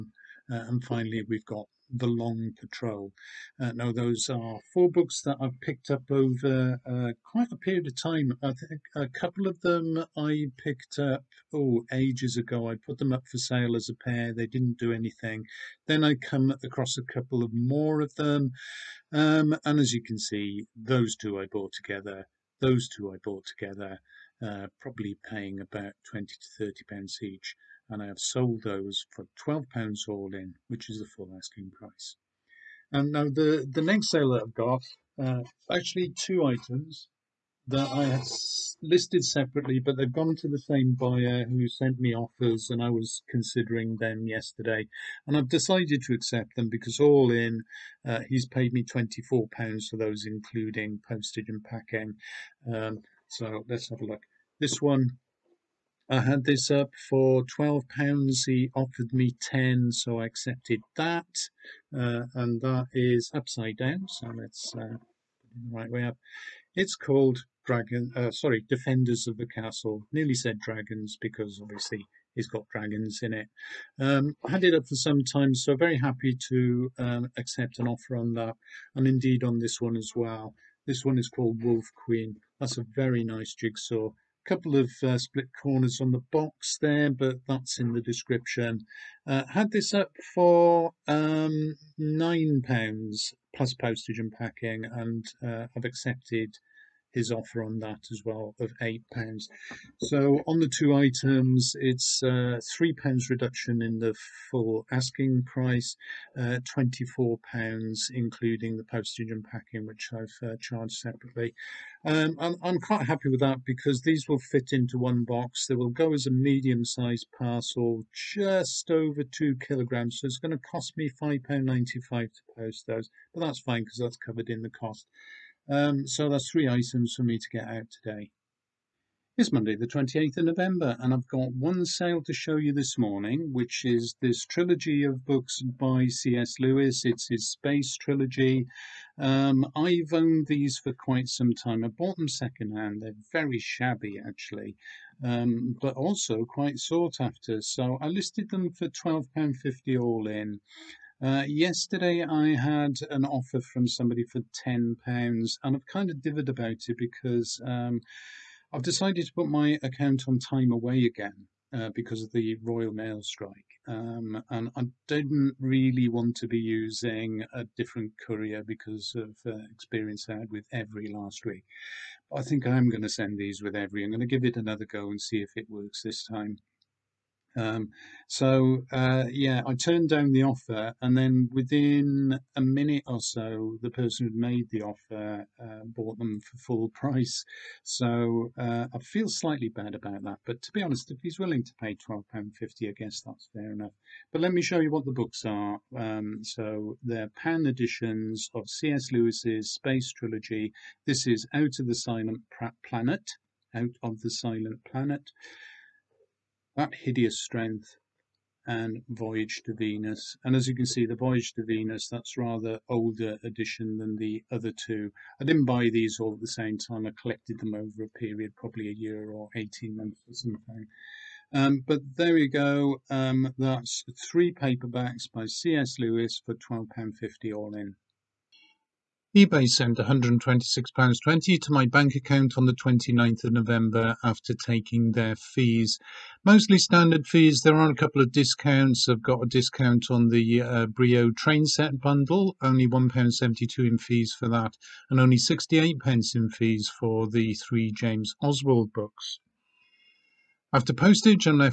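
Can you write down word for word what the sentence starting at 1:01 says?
Uh, and that is upside down, so it's us uh, right way up.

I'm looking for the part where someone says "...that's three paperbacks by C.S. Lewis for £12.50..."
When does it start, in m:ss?
3:43.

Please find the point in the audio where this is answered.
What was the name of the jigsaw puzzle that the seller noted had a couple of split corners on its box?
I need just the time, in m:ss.
1:21.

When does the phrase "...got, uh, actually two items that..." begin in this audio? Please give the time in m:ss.
0:34.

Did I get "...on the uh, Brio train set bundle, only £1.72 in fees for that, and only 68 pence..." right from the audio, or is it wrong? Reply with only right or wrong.
right.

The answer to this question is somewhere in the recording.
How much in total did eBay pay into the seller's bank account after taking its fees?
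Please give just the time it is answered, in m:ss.
3:49.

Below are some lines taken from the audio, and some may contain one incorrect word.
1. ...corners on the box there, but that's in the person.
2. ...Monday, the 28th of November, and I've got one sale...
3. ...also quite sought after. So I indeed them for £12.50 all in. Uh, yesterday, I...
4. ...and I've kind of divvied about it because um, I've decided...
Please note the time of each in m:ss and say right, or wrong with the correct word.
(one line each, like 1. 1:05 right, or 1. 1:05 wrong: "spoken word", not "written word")
1. 1:25 wrong: "description", not "person"
2. 2:09 right
3. 2:25 wrong: "listed", not "indeed"
4. 2:35 right.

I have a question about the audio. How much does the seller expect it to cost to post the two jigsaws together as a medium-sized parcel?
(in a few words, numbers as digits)
£5.95.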